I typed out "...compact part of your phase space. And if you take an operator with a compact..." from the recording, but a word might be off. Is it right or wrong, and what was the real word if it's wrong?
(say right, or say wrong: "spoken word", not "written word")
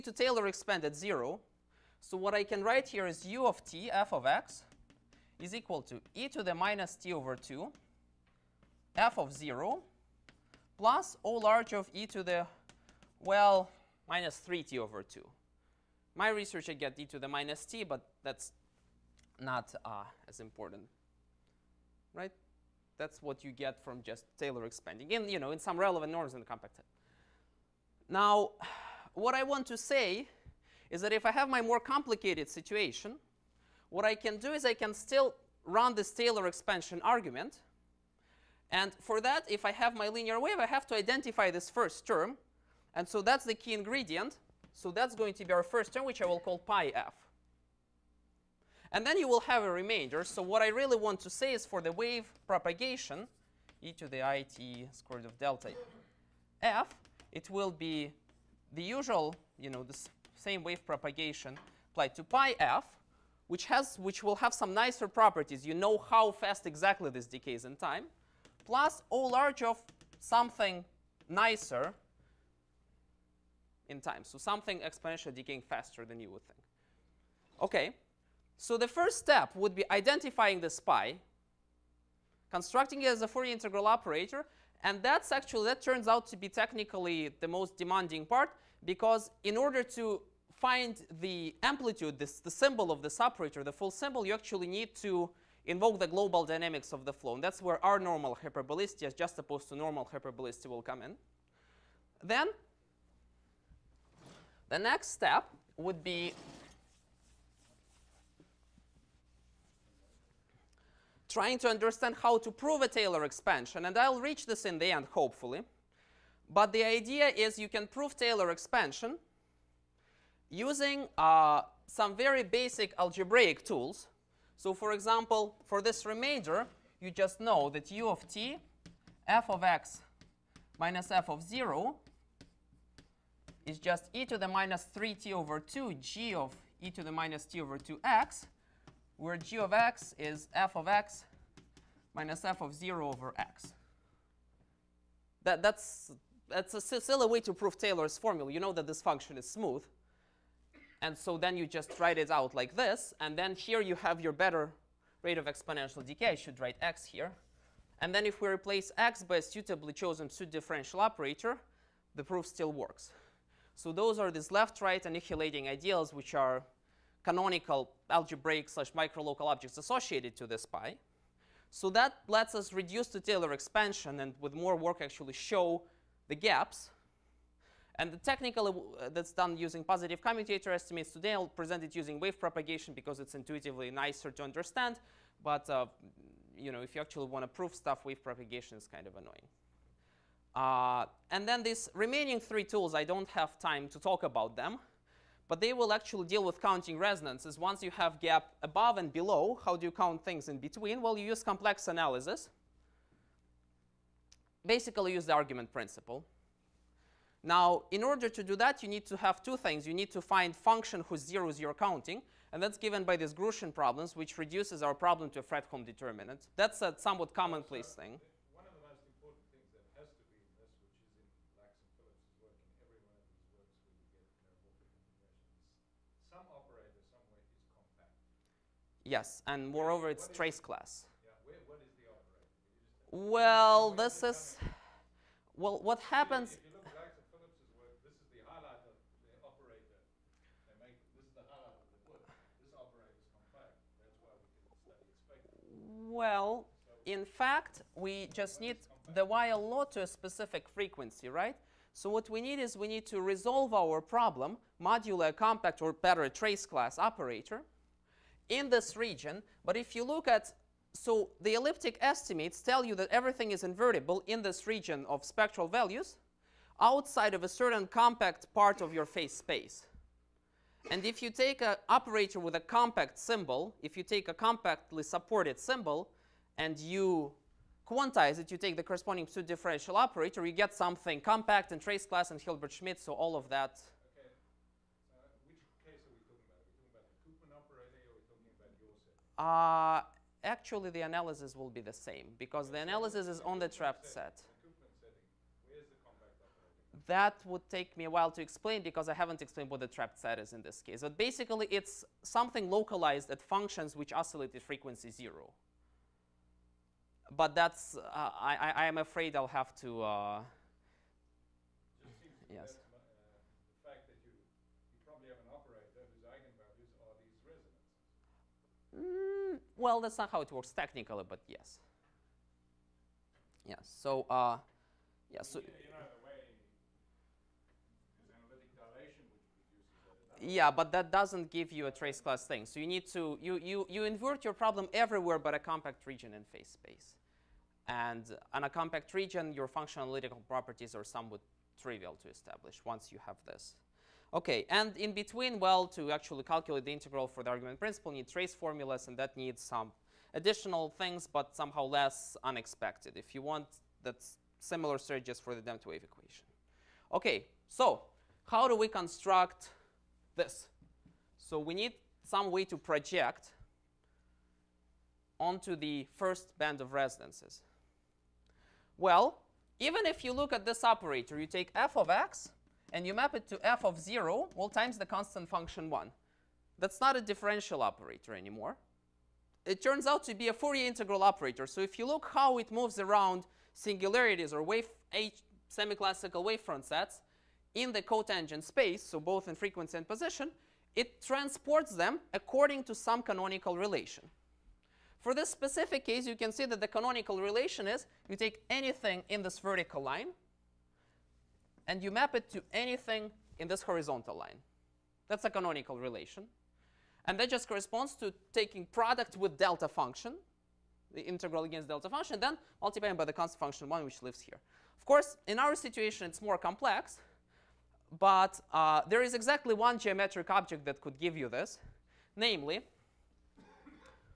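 right.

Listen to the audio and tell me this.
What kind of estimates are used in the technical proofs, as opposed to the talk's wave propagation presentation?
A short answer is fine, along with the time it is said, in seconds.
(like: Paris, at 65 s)
positive commutator estimates, at 179 s.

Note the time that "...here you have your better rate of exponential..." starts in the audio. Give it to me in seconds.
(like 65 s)
153 s.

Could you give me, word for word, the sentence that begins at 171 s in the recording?
So that lets us reduce the Taylor expansion and with more work actually show the gaps.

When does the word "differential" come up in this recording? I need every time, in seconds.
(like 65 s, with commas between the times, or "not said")
160 s, 279 s, 377 s.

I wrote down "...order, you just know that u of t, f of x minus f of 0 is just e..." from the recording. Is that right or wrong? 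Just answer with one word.
wrong.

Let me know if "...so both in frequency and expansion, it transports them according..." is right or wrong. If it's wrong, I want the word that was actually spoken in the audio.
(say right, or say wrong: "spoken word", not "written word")
wrong: "position", not "expansion".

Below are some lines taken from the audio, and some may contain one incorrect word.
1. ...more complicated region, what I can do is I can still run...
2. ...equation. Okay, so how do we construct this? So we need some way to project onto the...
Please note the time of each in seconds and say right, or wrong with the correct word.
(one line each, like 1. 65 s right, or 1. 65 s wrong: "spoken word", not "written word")
1. 31 s wrong: "situation", not "region"
2. 356 s right.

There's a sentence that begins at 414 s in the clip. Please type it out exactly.
Of course, in our situation, it's more complex.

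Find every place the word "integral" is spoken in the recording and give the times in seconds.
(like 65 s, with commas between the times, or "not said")
83 s, 346 s, 380 s, 411 s.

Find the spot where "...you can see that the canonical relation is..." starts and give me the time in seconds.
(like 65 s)
396 s.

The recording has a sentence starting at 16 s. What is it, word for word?
My research, I get e to the minus t, but that's not uh, as important right?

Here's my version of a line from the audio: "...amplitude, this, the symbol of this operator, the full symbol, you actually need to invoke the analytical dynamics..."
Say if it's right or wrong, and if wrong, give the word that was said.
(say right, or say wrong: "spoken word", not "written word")
wrong: "global", not "analytical".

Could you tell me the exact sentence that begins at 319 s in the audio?
Well, that's not how it works technically, but yes.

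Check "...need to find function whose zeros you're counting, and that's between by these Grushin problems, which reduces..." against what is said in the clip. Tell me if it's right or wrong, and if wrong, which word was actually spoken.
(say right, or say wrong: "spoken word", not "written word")
wrong: "given", not "between".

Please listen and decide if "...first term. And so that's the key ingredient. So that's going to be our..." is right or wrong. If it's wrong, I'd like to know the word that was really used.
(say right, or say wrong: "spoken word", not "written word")
right.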